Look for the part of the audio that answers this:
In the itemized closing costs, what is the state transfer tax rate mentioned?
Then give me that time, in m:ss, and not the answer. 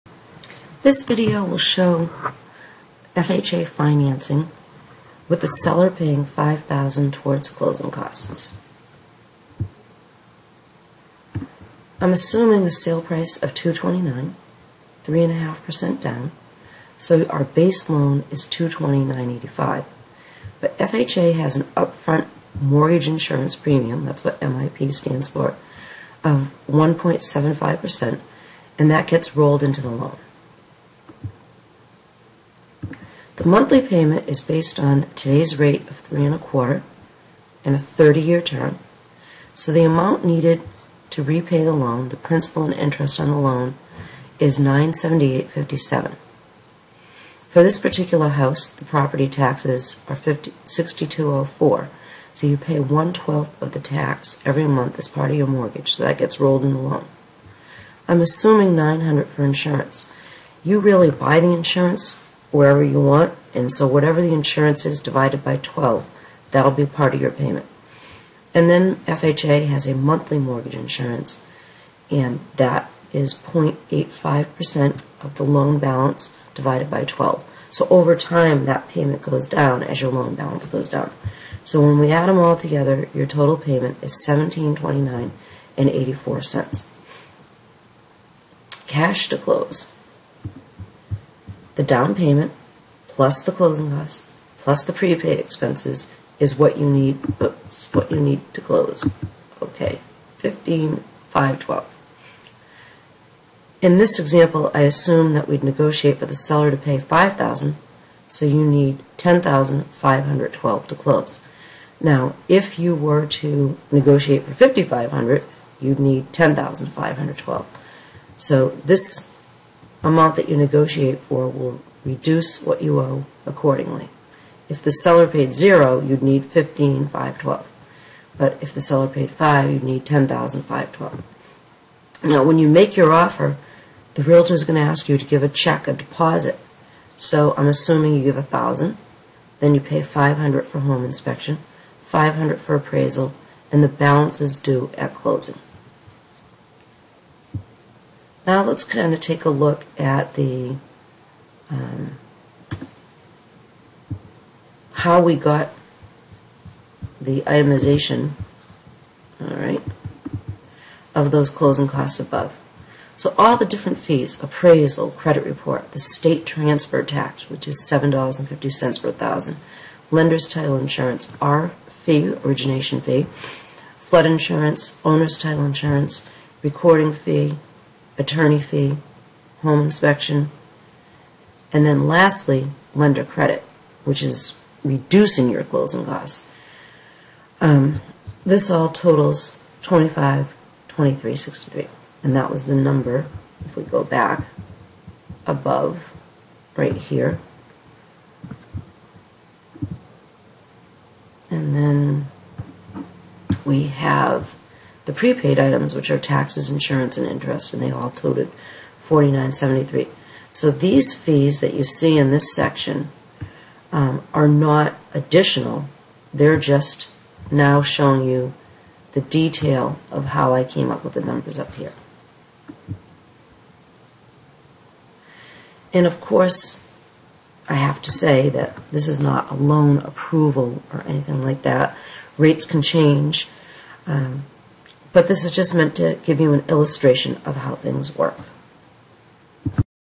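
2:47.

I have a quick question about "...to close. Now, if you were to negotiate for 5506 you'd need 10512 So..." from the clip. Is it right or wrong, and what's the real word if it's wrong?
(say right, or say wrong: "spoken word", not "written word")
wrong: "5500", not "5506".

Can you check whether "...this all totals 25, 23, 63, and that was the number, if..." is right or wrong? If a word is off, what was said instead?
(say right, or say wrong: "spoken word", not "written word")
right.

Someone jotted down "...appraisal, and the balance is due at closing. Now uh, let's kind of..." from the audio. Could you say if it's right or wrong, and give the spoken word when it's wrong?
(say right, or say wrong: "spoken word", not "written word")
right.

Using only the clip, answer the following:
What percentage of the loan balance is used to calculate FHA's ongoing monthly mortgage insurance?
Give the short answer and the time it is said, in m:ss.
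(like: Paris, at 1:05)
0.85%, at 1:13.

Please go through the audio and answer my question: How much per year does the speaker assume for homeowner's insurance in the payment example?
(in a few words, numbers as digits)
900.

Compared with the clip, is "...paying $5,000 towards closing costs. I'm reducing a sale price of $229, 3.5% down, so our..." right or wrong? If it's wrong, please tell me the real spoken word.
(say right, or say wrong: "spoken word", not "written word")
wrong: "assuming", not "reducing".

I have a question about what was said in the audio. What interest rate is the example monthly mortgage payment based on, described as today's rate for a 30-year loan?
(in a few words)
3.25%.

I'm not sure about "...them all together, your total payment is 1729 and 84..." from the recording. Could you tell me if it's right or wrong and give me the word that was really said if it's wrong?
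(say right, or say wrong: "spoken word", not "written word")
right.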